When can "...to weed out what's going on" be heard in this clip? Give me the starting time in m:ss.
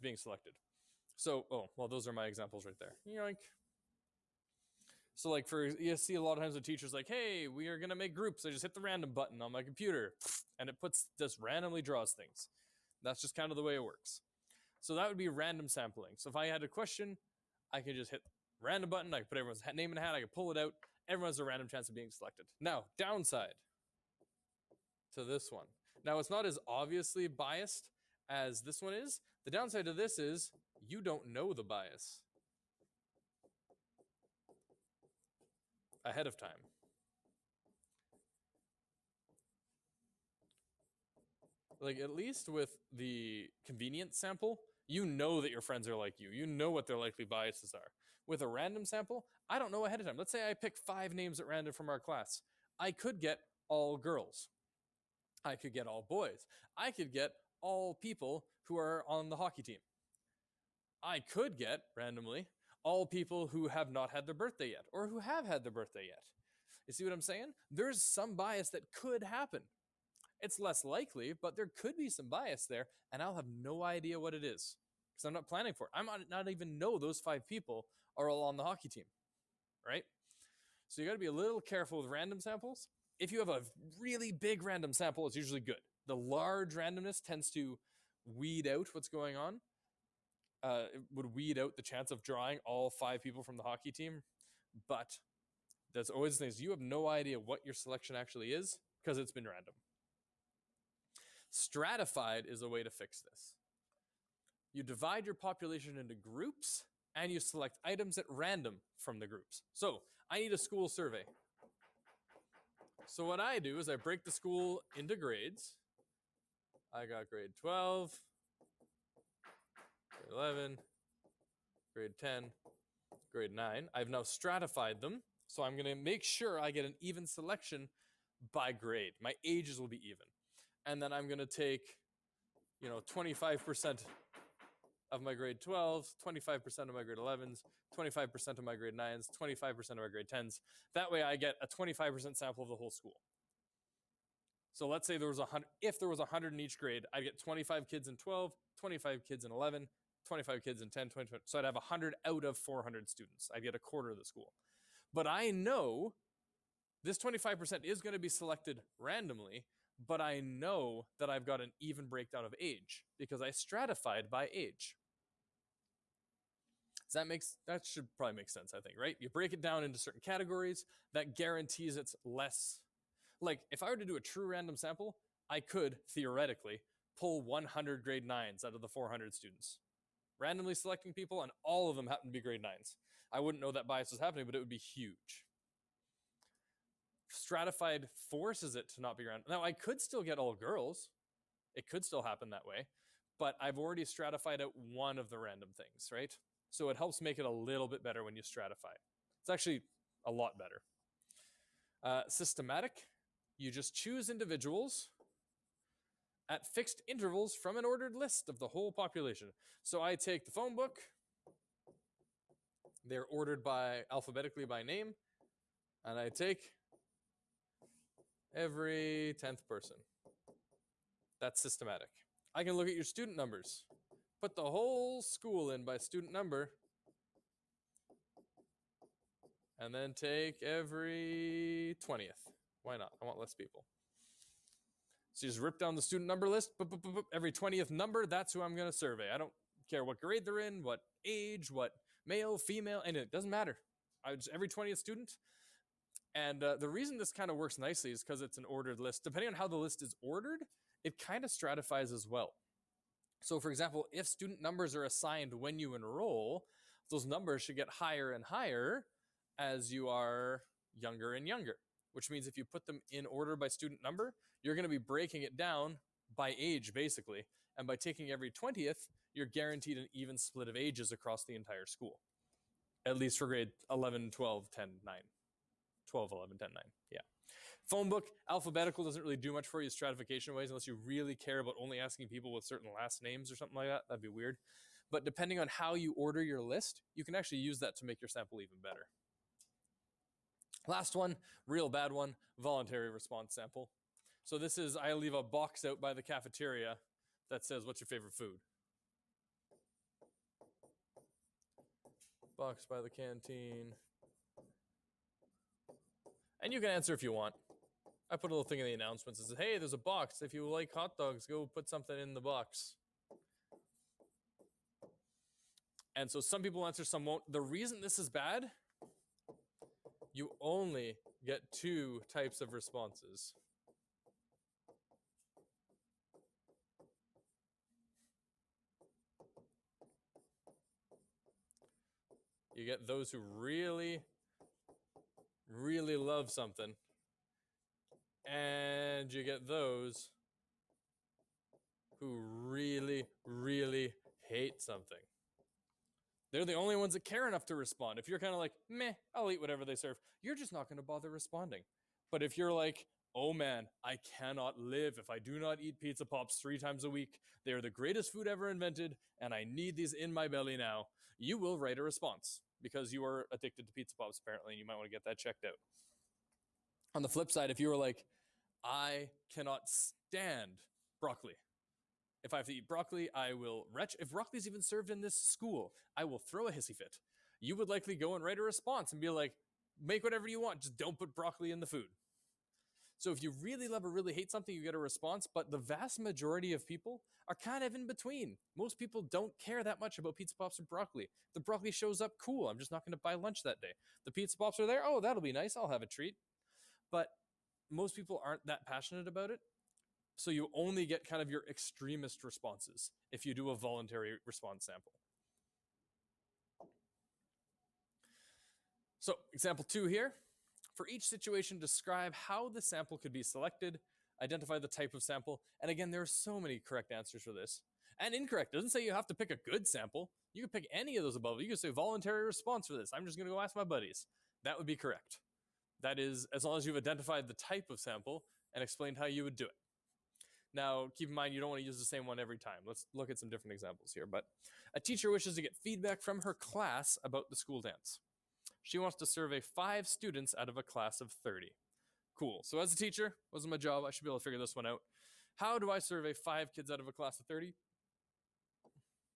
1:27.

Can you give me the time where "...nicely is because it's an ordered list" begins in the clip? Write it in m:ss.
4:07.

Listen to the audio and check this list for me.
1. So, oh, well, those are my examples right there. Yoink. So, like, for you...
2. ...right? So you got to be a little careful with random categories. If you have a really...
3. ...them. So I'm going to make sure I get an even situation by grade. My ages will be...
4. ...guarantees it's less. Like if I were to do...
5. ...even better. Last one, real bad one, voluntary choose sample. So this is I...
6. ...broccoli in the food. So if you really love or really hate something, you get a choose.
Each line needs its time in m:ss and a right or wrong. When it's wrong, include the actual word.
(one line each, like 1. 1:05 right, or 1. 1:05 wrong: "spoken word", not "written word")
1. 0:01 right
2. 1:19 wrong: "samples", not "categories"
3. 2:05 wrong: "selection", not "situation"
4. 2:51 right
5. 4:48 wrong: "response", not "choose"
6. 6:21 wrong: "response", not "choose".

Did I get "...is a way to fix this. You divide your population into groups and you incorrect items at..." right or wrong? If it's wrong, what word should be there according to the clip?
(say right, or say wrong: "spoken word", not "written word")
wrong: "select", not "incorrect".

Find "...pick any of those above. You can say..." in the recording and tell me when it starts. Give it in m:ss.
7:00.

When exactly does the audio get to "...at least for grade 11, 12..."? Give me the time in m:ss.
4:33.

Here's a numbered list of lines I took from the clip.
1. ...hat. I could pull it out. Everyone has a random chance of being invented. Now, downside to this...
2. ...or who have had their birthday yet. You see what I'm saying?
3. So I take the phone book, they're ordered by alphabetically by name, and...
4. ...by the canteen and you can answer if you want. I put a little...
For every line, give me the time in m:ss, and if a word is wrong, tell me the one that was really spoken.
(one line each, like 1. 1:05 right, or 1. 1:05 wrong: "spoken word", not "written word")
1. 0:20 wrong: "selected", not "invented"
2. 1:04 right
3. 3:29 right
4. 5:02 right.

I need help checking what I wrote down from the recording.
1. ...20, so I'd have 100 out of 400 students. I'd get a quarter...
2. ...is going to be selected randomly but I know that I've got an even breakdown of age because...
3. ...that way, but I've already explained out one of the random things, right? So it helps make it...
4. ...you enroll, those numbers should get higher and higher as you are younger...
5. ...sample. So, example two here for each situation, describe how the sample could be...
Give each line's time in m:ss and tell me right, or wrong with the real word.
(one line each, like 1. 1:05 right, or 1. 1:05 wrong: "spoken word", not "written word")
1. 2:31 right
2. 2:37 right
3. 3:12 wrong: "stratified", not "explained"
4. 4:15 right
5. 6:44 right.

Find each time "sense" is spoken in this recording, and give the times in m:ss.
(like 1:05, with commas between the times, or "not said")
2:48.